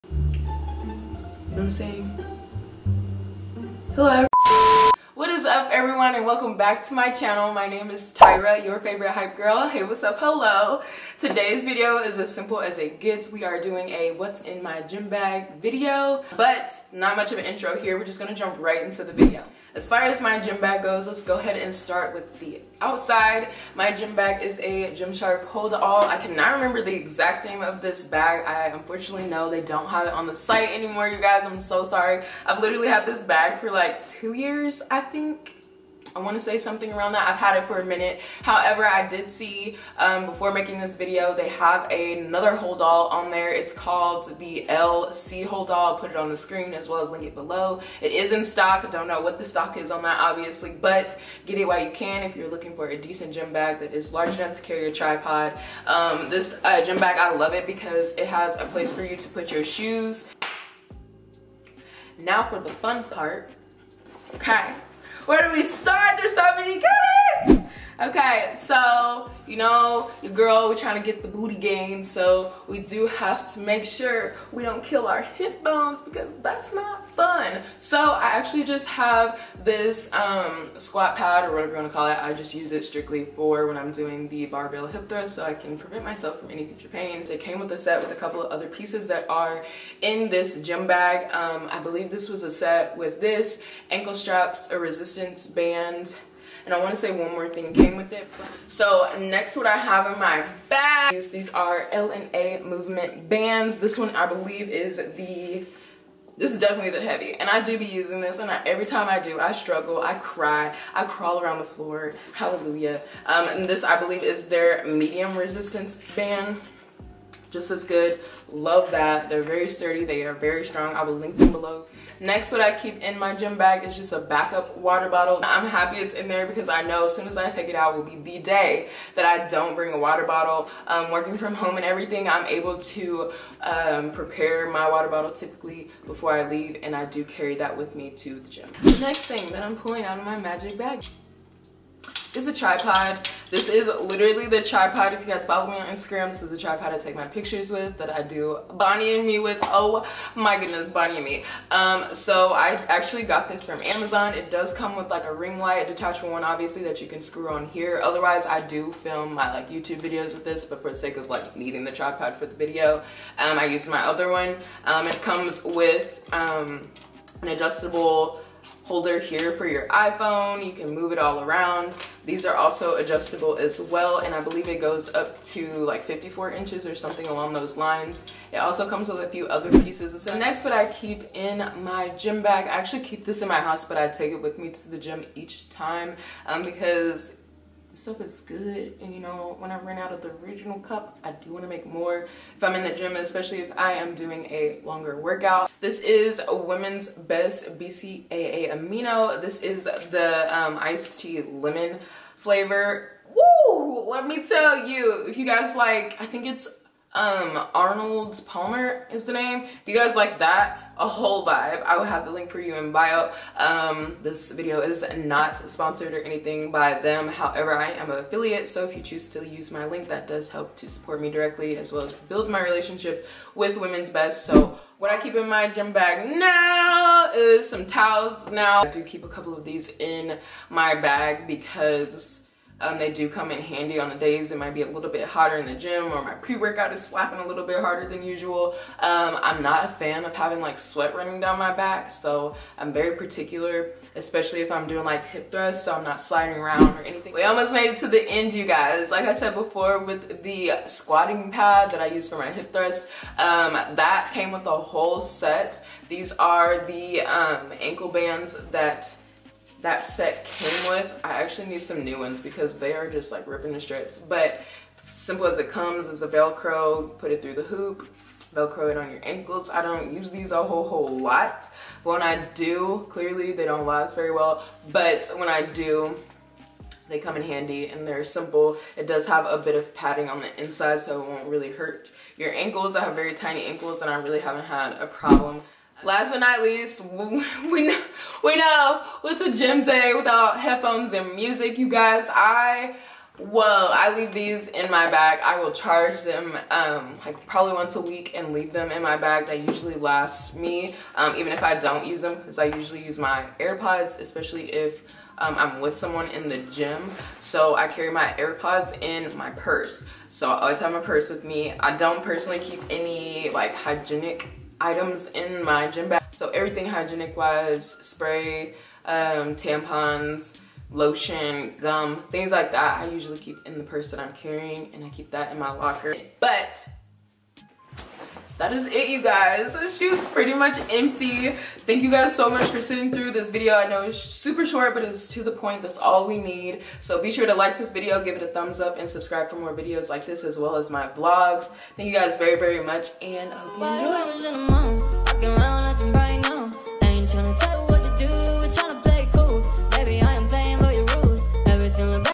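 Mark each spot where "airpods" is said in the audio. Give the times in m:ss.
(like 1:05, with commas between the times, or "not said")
5:03, 5:08.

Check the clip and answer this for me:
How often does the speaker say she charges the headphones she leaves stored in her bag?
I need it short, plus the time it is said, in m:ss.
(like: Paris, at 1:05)
Once a week, at 4:57.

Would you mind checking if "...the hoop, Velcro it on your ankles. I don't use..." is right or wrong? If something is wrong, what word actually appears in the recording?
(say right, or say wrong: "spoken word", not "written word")
right.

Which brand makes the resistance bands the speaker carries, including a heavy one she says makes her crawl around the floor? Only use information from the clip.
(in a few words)
L&A.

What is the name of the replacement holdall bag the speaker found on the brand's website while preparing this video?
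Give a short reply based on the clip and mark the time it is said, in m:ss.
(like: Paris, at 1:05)
LC holdall, at 0:44.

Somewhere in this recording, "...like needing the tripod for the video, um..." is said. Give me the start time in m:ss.
2:41.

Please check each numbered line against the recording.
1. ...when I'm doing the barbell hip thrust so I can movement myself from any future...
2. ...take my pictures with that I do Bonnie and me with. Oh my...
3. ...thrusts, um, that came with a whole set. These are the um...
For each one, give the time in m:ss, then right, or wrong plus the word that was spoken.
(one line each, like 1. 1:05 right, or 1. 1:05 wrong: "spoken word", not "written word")
1. 1:23 wrong: "prevent", not "movement"
2. 2:26 right
3. 4:12 right.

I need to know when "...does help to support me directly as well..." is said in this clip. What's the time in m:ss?
3:40.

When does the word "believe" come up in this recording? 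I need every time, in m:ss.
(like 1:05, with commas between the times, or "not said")
1:31, 1:44, 1:53, 2:54.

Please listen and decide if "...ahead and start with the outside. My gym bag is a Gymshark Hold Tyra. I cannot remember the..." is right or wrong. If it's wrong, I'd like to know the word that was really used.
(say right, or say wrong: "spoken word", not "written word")
wrong: "All", not "Tyra".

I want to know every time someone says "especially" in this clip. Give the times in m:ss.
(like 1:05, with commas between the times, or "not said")
3:13, 4:04, 5:04.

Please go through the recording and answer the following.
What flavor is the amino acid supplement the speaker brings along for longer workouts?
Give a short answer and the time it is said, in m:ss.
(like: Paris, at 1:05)
Iced tea lemon, at 3:20.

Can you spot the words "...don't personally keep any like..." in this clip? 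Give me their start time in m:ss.
5:11.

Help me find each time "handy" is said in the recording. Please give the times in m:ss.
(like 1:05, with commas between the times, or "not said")
3:53, 4:37.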